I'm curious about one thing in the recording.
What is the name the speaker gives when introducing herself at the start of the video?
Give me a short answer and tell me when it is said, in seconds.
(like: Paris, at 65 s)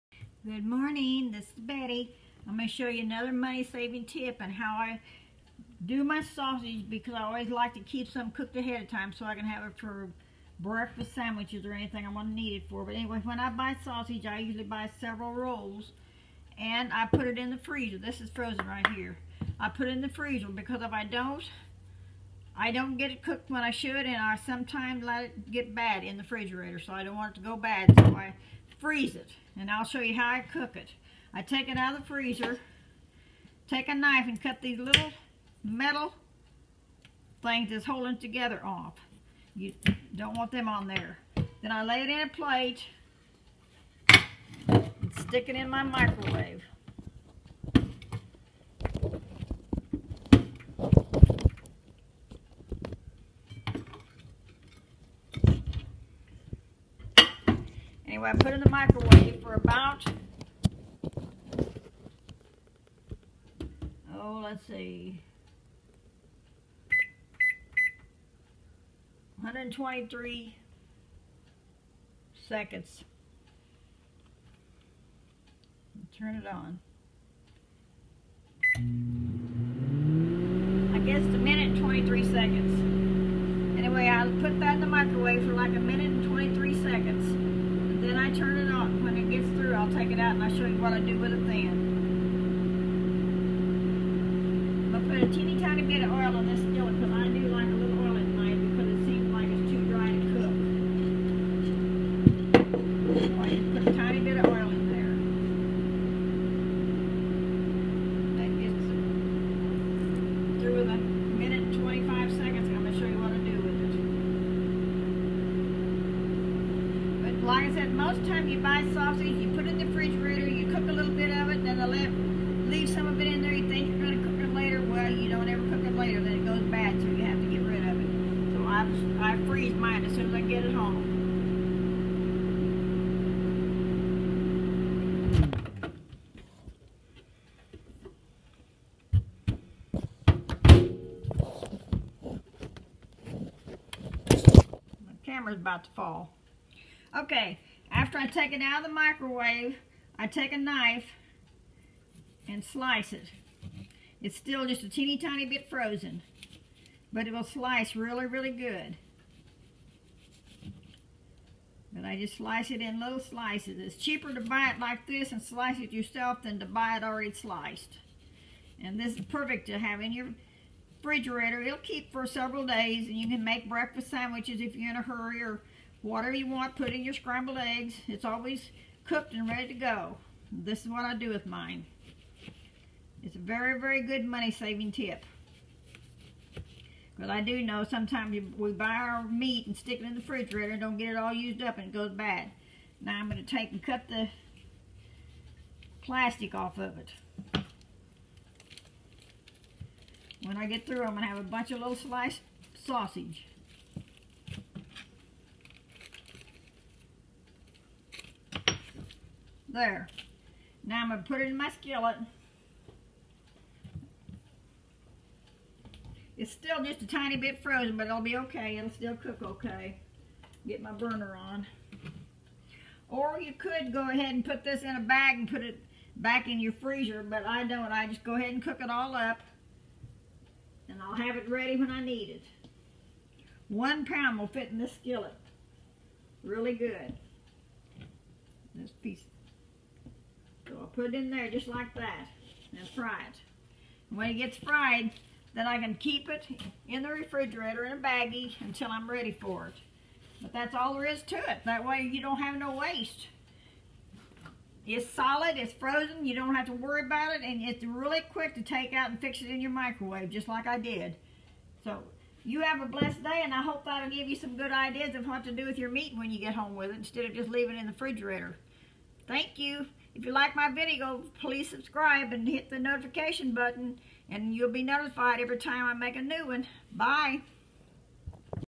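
Betty, at 1 s.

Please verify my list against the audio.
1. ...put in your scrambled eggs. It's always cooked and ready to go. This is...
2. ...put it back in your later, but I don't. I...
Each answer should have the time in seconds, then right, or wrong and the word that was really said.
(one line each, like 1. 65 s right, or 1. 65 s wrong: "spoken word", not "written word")
1. 176 s right
2. 225 s wrong: "freezer", not "later".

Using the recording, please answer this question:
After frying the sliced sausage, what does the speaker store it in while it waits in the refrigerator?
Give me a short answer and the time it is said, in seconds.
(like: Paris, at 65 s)
a baggie, at 247 s.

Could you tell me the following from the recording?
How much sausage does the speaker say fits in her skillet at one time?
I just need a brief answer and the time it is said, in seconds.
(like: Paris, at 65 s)
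1 pound, at 233 s.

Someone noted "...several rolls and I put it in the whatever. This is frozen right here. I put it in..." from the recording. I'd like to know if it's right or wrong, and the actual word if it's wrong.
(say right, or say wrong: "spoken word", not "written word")
wrong: "freezer", not "whatever".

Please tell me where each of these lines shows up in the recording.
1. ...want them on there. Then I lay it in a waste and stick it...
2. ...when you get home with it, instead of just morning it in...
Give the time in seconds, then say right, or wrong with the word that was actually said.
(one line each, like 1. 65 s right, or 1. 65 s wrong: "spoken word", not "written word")
1. 40 s wrong: "plate", not "waste"
2. 266 s wrong: "leaving", not "morning".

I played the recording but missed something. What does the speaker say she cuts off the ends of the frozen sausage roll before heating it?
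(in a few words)
little metal things.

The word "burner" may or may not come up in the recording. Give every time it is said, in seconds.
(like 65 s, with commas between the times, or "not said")
220 s.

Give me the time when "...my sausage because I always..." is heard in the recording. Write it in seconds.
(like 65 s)
6 s.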